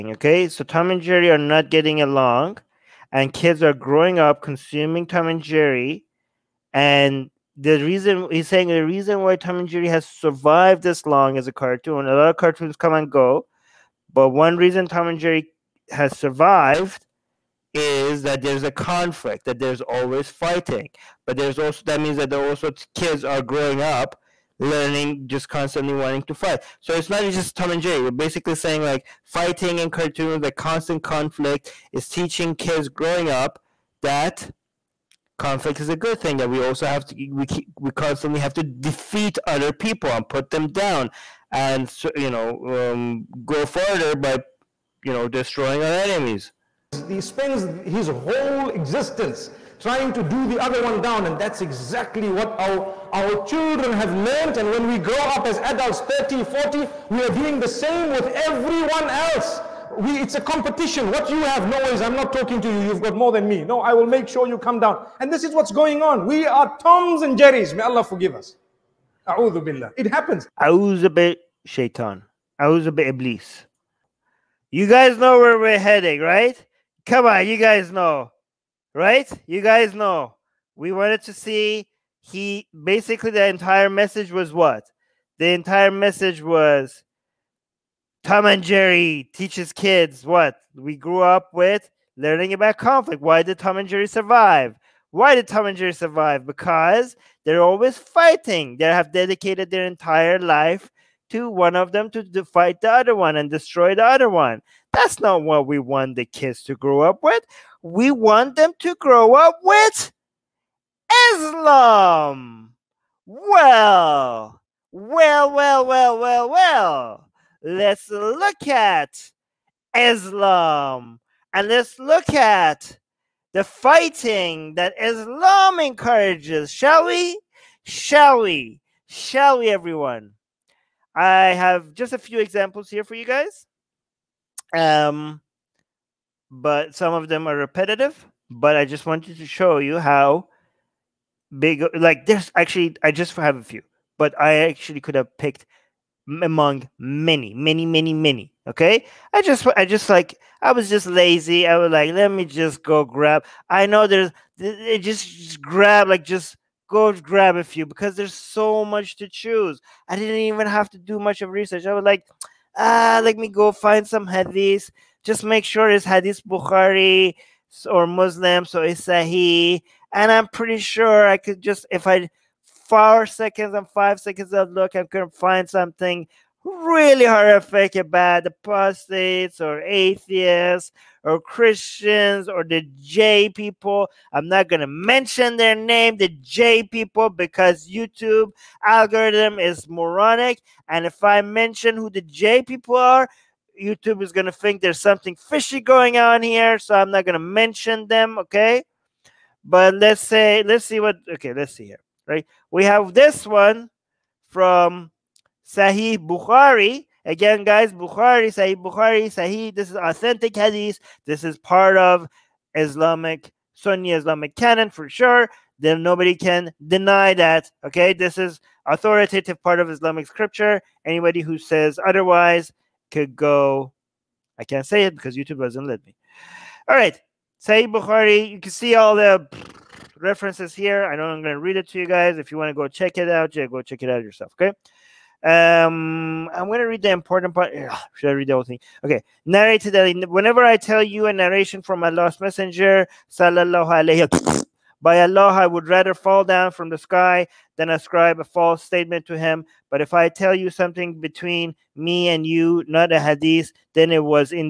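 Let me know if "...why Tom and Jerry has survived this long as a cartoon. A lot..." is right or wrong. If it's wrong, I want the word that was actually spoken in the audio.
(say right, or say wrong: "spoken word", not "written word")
right.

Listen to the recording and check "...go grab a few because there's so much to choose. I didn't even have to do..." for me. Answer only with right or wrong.
right.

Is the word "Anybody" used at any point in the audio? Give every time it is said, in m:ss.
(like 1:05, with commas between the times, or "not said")
3:41.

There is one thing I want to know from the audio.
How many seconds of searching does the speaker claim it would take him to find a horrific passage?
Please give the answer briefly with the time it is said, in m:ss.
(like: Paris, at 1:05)
4 or 5 seconds, at 2:52.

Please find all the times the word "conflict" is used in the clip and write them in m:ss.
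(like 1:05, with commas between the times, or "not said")
0:18, 0:31, 0:35, 1:32.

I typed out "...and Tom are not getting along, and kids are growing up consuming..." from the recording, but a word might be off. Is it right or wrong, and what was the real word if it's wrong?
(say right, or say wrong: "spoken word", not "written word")
wrong: "Jerry", not "Tom".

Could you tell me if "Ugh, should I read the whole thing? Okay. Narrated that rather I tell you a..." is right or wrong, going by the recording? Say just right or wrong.
wrong.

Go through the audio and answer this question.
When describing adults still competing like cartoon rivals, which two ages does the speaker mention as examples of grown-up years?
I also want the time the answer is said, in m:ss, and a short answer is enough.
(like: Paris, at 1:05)
30, 40, at 0:56.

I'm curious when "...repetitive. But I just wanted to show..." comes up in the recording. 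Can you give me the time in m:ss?
2:17.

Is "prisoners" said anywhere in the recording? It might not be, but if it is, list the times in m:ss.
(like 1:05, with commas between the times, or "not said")
not said.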